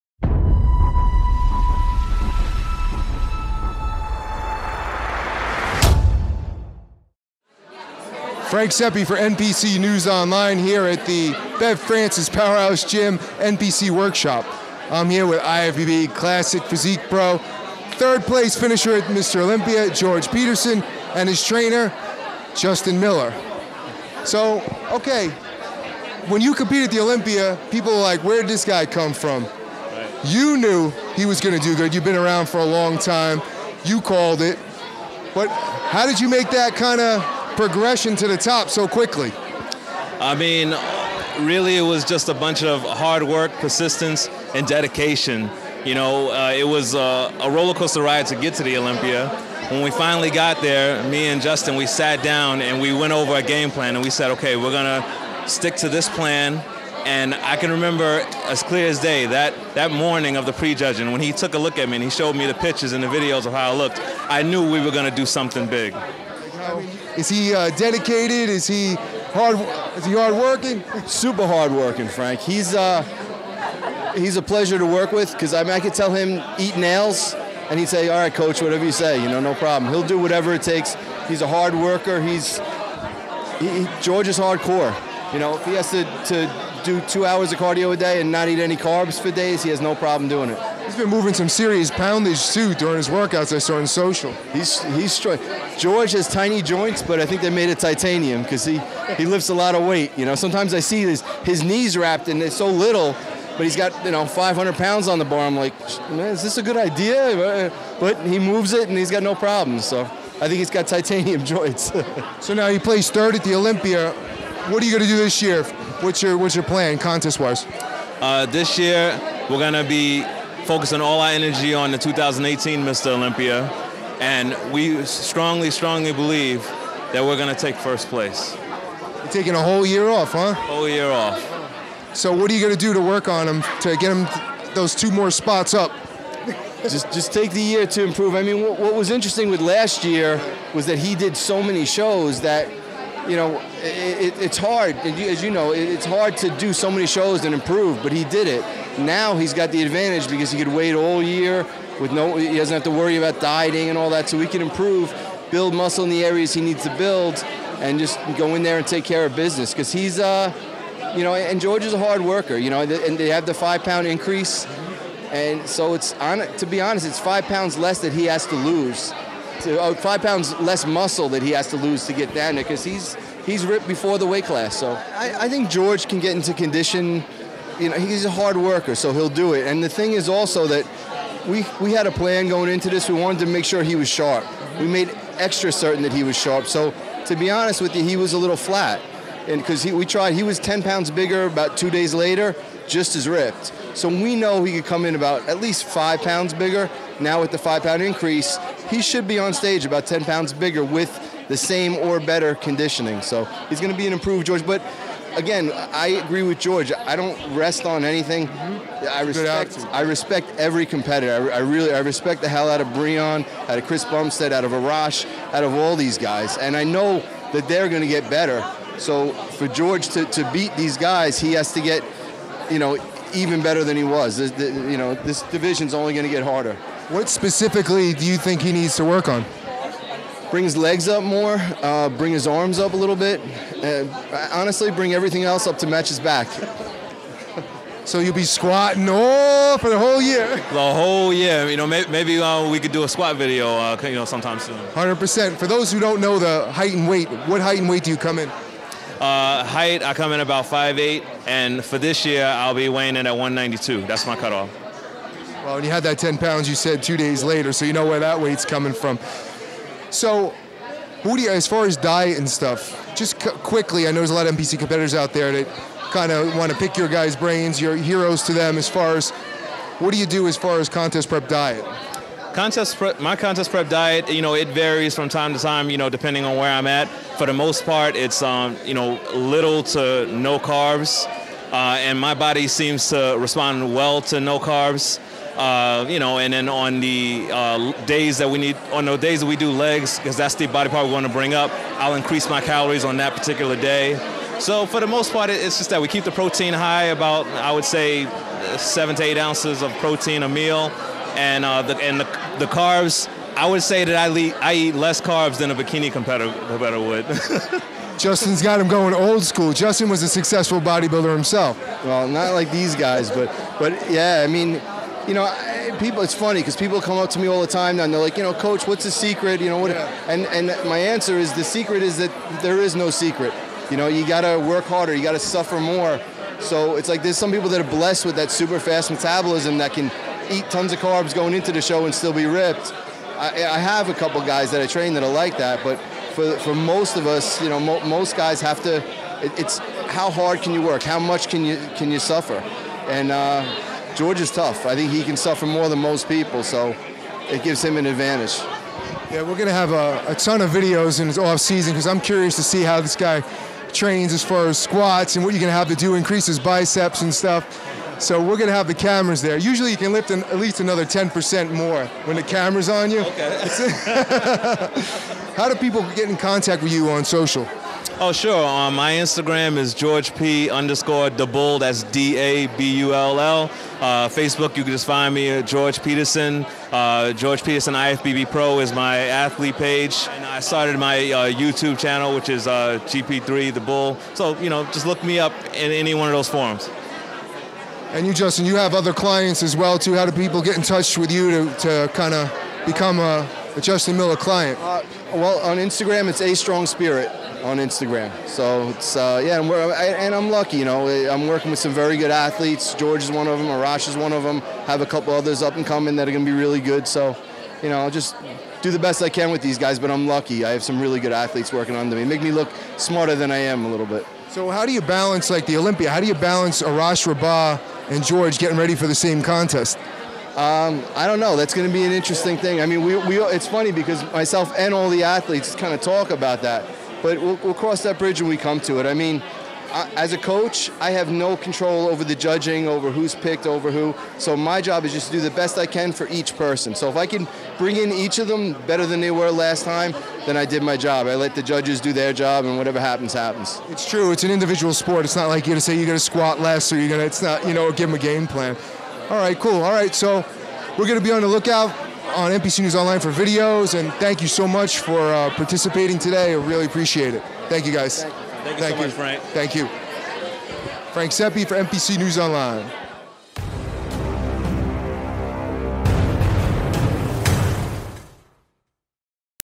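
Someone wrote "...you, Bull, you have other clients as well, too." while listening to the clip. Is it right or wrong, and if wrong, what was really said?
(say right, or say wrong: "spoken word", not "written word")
wrong: "Justin", not "Bull".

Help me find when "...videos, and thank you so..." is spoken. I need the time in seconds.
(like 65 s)
453 s.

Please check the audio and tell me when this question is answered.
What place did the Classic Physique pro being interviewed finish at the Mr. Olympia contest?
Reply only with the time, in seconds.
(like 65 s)
17 s.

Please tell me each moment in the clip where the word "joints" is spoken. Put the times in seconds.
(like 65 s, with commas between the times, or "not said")
96 s, 111 s.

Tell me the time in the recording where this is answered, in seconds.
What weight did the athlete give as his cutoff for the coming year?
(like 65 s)
253 s.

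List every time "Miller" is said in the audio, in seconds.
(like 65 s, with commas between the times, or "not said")
22 s, 394 s.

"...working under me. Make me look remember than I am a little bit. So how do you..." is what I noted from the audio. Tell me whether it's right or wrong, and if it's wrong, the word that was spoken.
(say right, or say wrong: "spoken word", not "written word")
wrong: "smarter", not "remember".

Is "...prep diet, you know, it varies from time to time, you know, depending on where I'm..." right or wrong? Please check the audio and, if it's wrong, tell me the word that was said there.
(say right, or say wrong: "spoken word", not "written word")
right.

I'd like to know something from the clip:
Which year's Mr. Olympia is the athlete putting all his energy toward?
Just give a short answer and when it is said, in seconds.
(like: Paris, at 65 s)
2018, at 121 s.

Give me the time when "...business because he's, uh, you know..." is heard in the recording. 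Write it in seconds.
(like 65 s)
159 s.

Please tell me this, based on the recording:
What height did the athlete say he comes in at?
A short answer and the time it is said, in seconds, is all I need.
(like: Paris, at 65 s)
5'8", at 250 s.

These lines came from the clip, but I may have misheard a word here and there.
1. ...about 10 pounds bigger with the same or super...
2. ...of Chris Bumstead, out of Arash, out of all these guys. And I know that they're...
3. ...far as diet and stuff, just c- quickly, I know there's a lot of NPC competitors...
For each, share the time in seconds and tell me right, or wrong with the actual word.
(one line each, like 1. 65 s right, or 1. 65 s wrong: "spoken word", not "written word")
1. 199 s wrong: "better", not "super"
2. 213 s right
3. 261 s right.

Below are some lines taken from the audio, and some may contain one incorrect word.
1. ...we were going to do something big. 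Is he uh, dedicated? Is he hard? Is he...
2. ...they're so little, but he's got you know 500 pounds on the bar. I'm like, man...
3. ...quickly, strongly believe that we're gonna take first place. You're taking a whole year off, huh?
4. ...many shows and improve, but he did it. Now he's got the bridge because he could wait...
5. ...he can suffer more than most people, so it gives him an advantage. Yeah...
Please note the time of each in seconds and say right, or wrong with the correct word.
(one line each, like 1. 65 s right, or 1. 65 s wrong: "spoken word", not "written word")
1. 64 s right
2. 102 s right
3. 125 s wrong: "strongly", not "quickly"
4. 146 s wrong: "advantage", not "bridge"
5. 345 s right.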